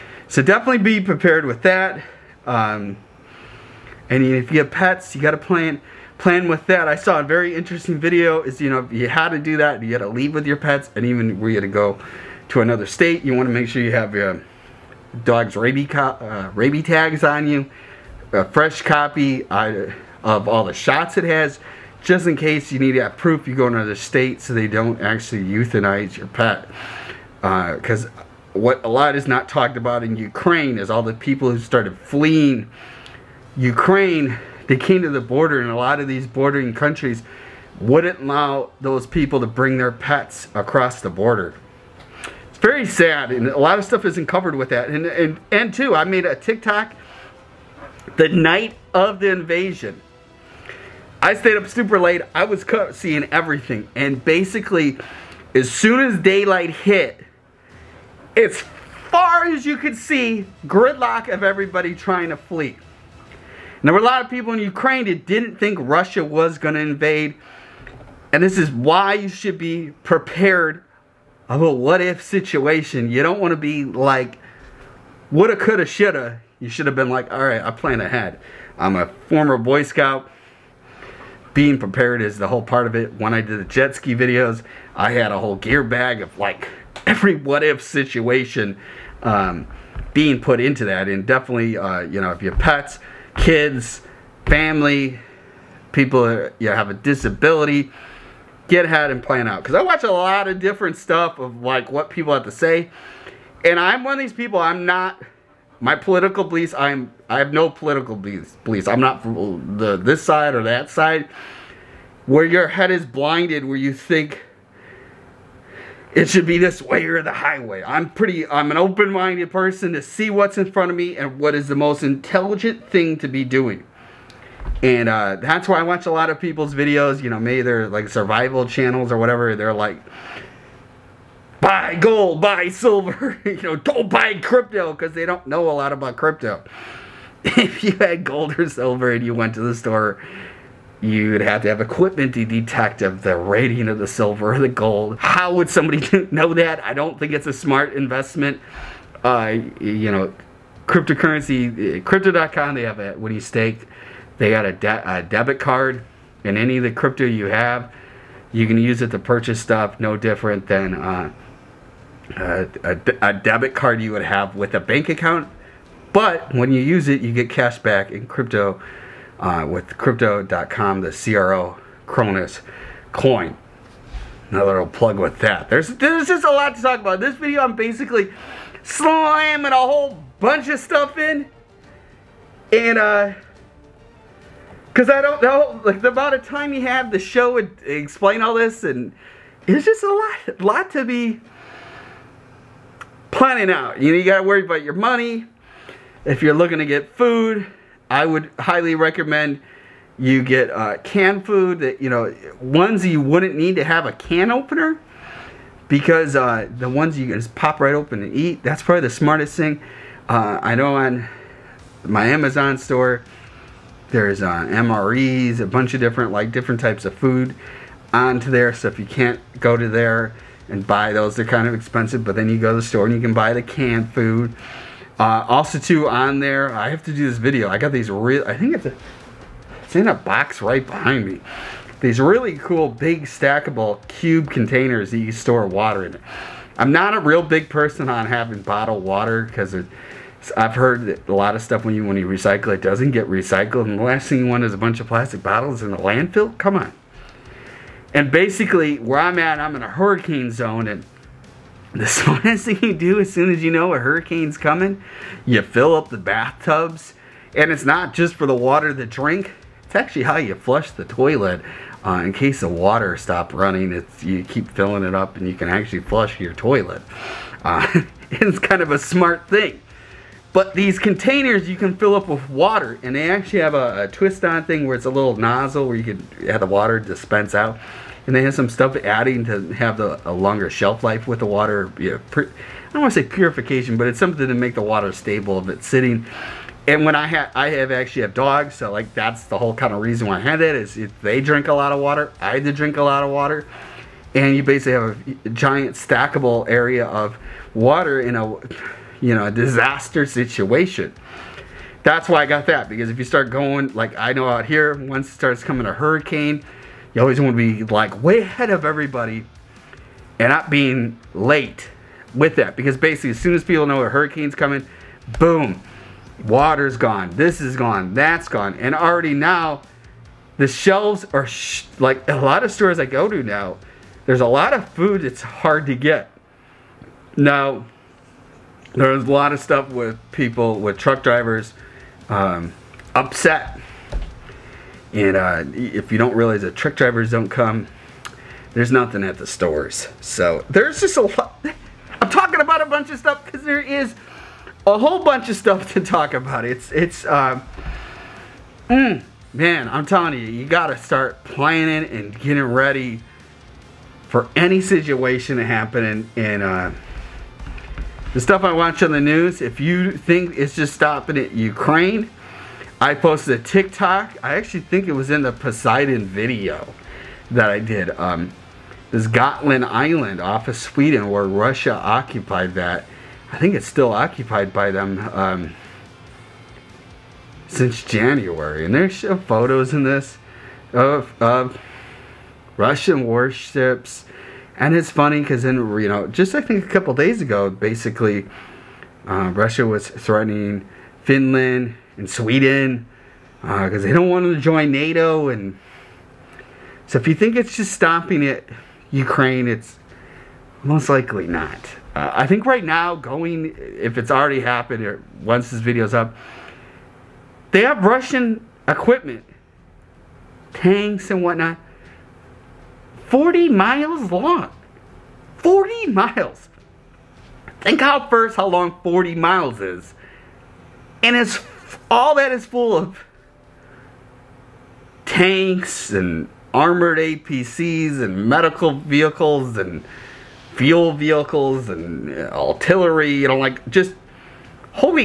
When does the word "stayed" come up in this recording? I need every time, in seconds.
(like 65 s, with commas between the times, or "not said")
51 s.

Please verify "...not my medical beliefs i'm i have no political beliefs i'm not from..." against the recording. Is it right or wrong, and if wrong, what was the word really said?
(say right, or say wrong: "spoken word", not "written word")
wrong: "political", not "medical".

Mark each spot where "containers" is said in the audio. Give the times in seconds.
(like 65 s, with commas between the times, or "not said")
234 s, 270 s.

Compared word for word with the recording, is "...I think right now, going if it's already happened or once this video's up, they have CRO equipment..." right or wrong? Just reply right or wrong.
wrong.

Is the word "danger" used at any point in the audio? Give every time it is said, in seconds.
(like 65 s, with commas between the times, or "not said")
not said.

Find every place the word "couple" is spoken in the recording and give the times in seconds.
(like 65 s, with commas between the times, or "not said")
386 s.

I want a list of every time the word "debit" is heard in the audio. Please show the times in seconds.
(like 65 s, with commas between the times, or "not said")
155 s, 163 s.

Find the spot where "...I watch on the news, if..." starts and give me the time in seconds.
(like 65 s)
358 s.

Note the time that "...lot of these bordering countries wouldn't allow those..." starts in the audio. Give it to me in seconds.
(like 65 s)
35 s.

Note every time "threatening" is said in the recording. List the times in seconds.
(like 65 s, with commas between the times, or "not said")
390 s.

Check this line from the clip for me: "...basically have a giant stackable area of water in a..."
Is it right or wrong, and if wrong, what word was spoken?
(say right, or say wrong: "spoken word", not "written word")
right.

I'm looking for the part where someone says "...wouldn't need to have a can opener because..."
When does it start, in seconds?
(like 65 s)
203 s.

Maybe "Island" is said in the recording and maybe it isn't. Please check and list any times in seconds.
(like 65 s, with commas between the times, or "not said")
369 s.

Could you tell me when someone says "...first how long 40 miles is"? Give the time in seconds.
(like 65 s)
418 s.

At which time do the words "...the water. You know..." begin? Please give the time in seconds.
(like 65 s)
281 s.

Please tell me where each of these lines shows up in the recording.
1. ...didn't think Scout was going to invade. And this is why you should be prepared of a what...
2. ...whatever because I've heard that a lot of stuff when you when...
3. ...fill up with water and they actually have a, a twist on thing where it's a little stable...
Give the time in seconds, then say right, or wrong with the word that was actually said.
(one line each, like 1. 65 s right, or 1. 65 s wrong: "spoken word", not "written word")
1. 65 s wrong: "Russia", not "Scout"
2. 239 s wrong: "water", not "whatever"
3. 271 s wrong: "nozzle", not "stable".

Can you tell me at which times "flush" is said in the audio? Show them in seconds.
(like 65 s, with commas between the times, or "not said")
260 s, 265 s.